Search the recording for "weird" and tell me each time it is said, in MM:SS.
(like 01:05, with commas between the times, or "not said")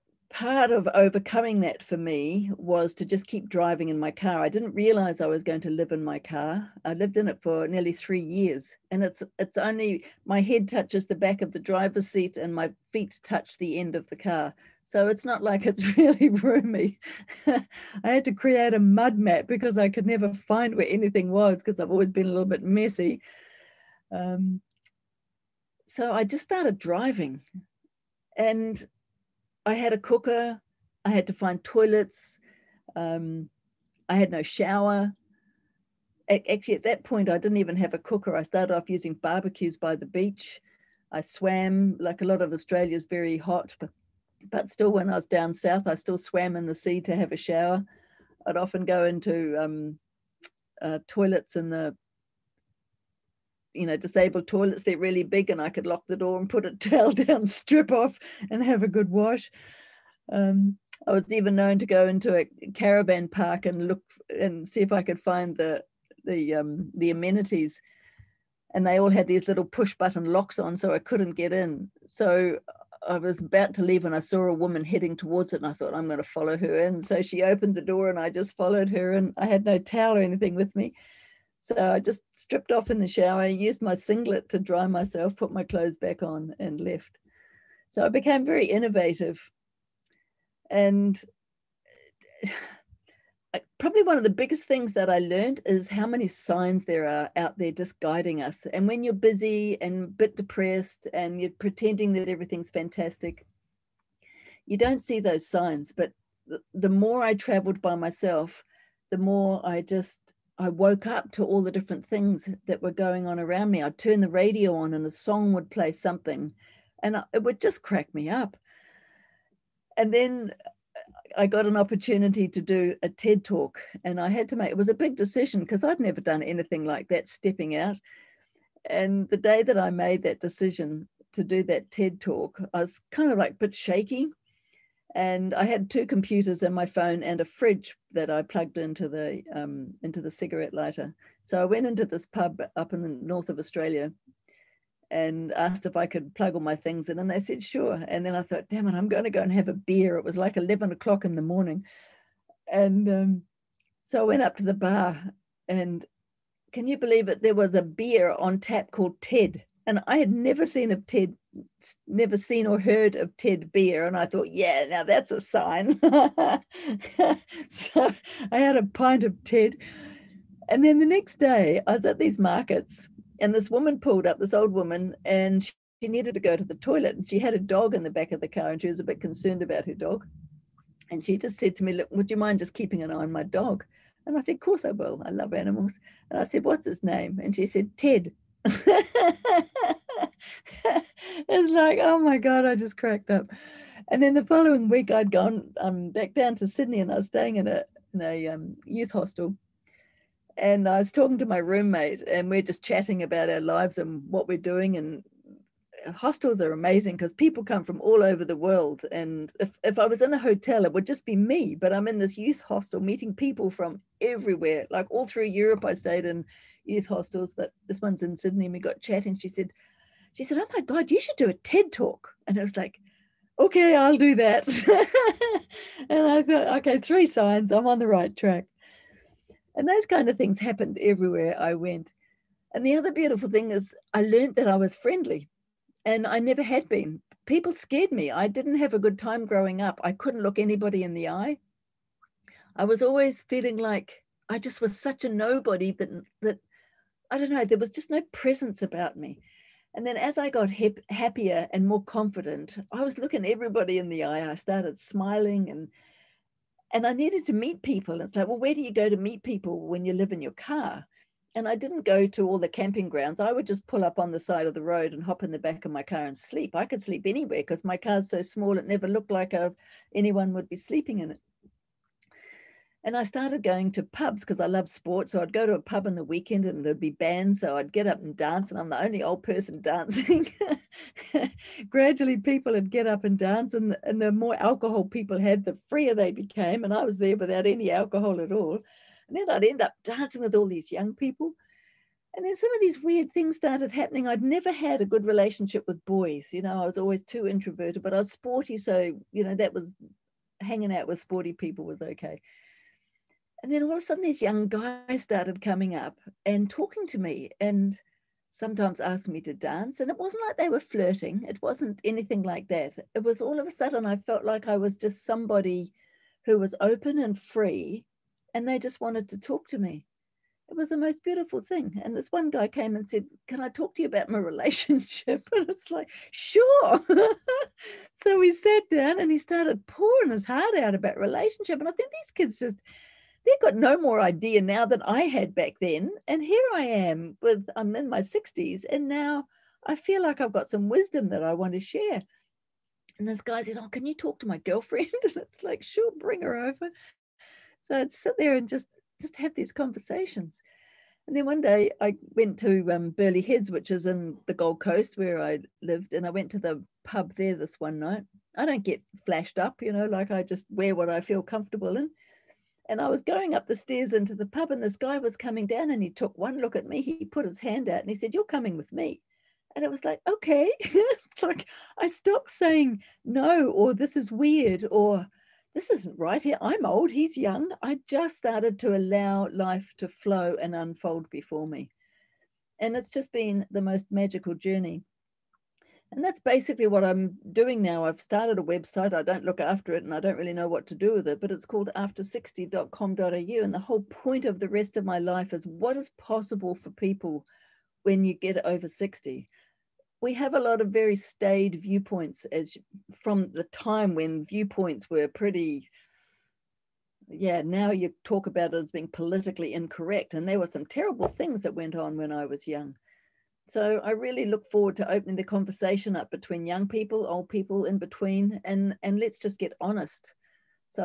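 04:53, 06:14.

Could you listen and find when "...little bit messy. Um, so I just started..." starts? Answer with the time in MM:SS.
00:22.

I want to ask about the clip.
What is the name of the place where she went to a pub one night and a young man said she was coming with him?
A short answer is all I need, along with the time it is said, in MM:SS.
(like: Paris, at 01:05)
Burleigh Heads, at 05:53.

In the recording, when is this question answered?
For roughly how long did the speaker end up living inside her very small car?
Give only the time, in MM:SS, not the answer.
00:07.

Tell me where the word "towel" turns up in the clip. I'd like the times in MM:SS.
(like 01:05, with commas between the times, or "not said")
00:56, 01:19.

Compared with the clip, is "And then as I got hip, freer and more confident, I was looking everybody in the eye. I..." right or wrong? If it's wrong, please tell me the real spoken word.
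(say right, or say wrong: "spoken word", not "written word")
wrong: "happier", not "freer".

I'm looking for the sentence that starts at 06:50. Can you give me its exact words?
And there were some terrible things that went on when I was young.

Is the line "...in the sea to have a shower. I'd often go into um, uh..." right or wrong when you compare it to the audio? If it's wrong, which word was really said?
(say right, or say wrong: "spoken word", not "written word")
right.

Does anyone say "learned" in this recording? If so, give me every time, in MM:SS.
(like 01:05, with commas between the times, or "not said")
01:35, 03:54.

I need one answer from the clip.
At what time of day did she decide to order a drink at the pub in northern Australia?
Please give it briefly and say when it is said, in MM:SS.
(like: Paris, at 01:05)
11 o'clock, at 02:30.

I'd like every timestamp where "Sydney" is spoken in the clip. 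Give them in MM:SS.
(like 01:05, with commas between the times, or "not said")
03:16, 03:38.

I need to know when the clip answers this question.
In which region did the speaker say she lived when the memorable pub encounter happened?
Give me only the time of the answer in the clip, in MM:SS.
05:54.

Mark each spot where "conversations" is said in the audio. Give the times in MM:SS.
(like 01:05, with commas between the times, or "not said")
05:49, 06:55.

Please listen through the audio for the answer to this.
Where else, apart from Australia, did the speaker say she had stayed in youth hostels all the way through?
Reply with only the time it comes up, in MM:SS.
03:35.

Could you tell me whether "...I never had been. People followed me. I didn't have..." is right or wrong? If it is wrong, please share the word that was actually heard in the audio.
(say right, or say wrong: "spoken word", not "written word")
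wrong: "scared", not "followed".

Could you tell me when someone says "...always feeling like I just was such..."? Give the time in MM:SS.
04:03.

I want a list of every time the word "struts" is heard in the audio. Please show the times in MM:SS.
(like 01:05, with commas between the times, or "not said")
not said.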